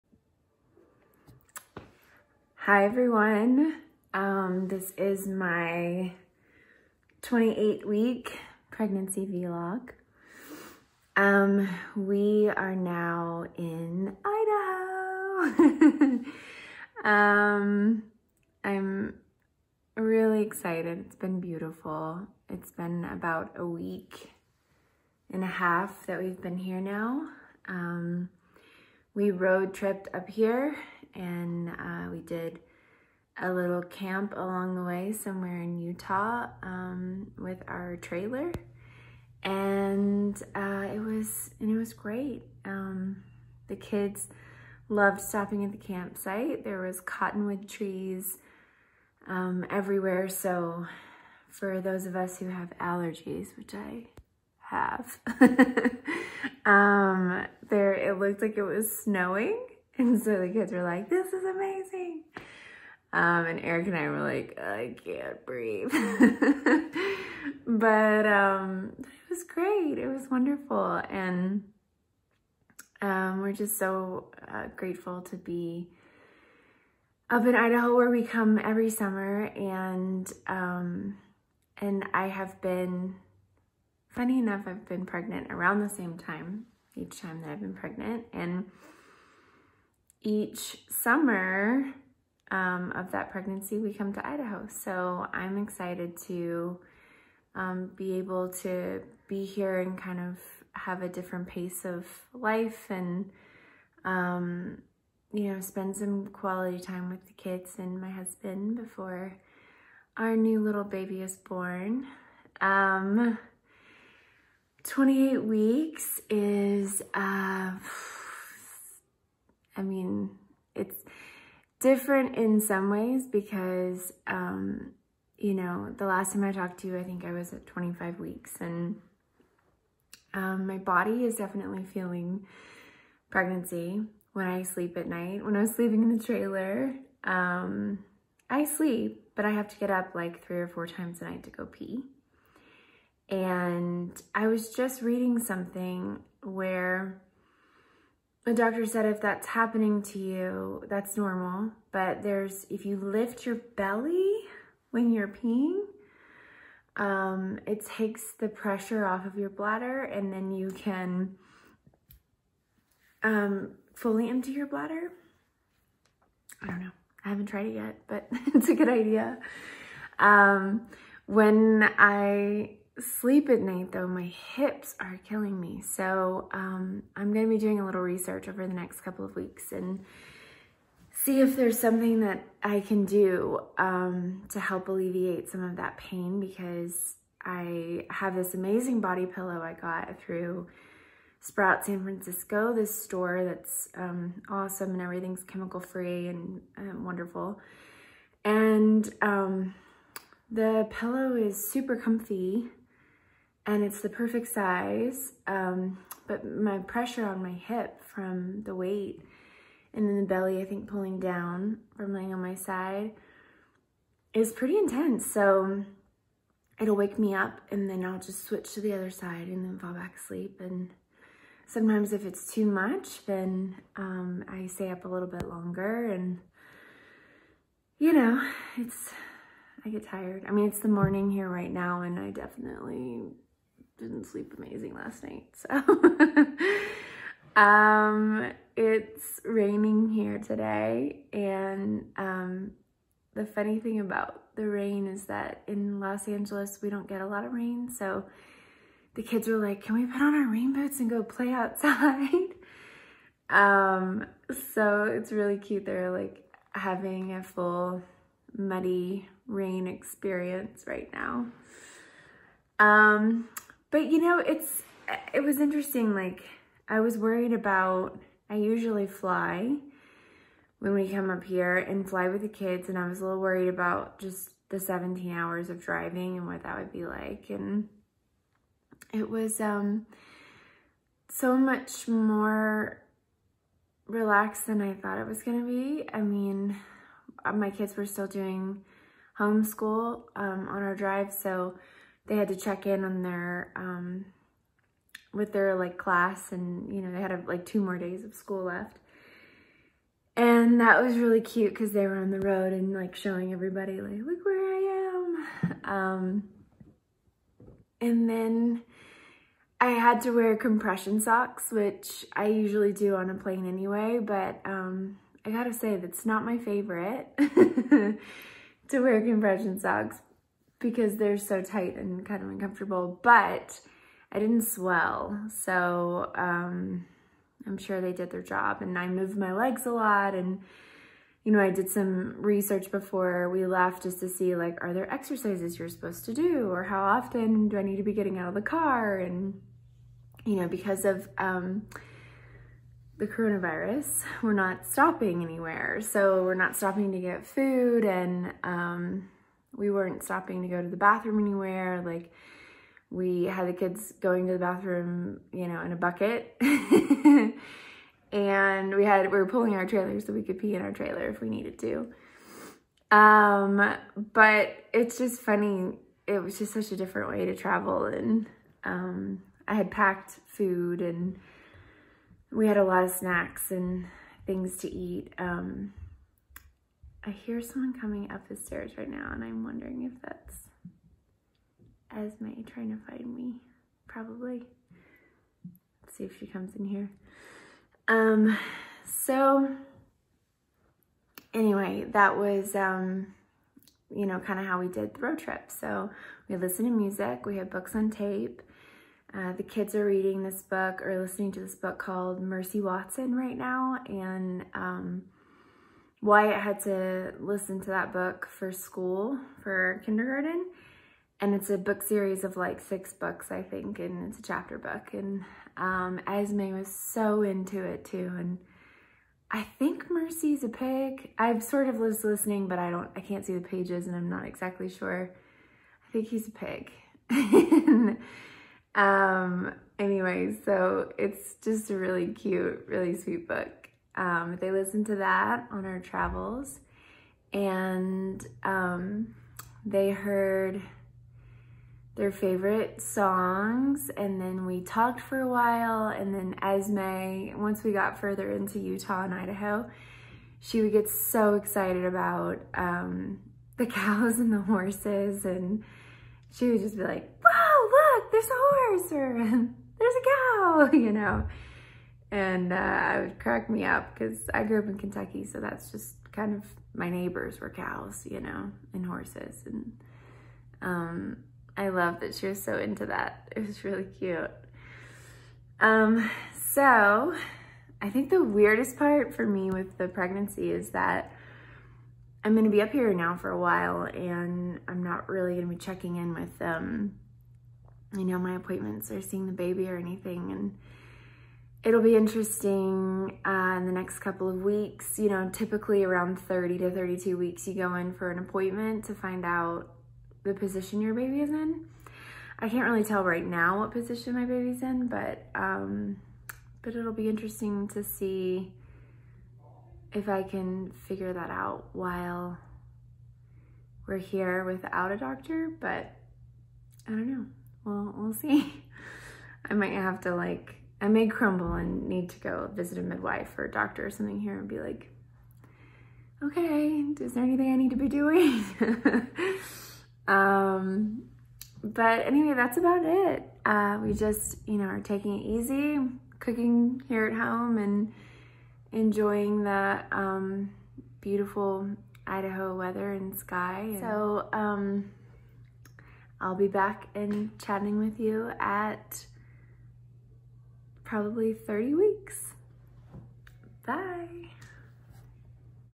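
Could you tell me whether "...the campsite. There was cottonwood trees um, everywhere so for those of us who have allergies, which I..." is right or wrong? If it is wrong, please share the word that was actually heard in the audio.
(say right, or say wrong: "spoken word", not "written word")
right.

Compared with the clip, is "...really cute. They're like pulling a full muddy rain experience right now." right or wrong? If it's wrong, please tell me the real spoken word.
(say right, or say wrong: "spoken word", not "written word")
wrong: "having", not "pulling".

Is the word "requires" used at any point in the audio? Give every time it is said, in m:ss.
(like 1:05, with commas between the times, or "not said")
not said.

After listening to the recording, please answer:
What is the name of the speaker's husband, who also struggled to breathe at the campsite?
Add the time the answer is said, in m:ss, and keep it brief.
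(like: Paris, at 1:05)
Eric, at 1:03.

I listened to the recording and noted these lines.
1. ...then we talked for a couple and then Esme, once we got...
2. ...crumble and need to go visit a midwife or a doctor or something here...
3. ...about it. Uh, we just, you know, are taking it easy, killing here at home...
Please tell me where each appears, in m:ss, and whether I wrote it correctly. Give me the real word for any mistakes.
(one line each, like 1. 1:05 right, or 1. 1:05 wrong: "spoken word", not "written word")
1. 7:24 wrong: "while", not "couple"
2. 8:41 right
3. 8:52 wrong: "cooking", not "killing".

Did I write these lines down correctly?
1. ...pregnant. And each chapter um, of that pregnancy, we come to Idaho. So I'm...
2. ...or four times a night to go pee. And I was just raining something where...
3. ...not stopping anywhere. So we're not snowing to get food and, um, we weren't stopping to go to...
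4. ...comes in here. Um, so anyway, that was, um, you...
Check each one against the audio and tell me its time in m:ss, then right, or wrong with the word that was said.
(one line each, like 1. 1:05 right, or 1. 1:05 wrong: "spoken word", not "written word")
1. 1:27 wrong: "summer", not "chapter"
2. 2:20 wrong: "reading", not "raining"
3. 5:44 wrong: "stopping", not "snowing"
4. 6:26 right.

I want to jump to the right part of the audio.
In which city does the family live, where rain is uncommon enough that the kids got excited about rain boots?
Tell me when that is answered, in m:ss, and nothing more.
4:05.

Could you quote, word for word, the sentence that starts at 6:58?
And I think Mercy's a pig.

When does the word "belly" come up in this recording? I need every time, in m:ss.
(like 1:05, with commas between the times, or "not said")
2:33, 3:30.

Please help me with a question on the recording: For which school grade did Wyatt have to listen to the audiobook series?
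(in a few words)
Kindergarten.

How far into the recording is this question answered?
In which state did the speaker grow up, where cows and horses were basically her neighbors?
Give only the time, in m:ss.
7:44.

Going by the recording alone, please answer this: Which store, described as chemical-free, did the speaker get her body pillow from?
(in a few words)
Sprout San Francisco.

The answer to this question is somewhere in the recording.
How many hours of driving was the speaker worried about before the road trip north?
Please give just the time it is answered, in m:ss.
4:34.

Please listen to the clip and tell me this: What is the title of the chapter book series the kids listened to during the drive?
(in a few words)
Mercy Watson.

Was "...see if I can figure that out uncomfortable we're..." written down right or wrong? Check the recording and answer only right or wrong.
wrong.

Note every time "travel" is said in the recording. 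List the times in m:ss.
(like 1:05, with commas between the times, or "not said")
6:07, 7:15.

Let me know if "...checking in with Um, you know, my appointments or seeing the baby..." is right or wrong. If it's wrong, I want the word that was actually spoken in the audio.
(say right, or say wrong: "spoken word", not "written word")
right.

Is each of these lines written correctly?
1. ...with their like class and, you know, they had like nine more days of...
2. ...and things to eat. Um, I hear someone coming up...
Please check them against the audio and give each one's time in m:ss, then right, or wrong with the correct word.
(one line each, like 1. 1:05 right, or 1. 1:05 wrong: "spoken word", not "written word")
1. 4:55 wrong: "two", not "nine"
2. 6:13 right.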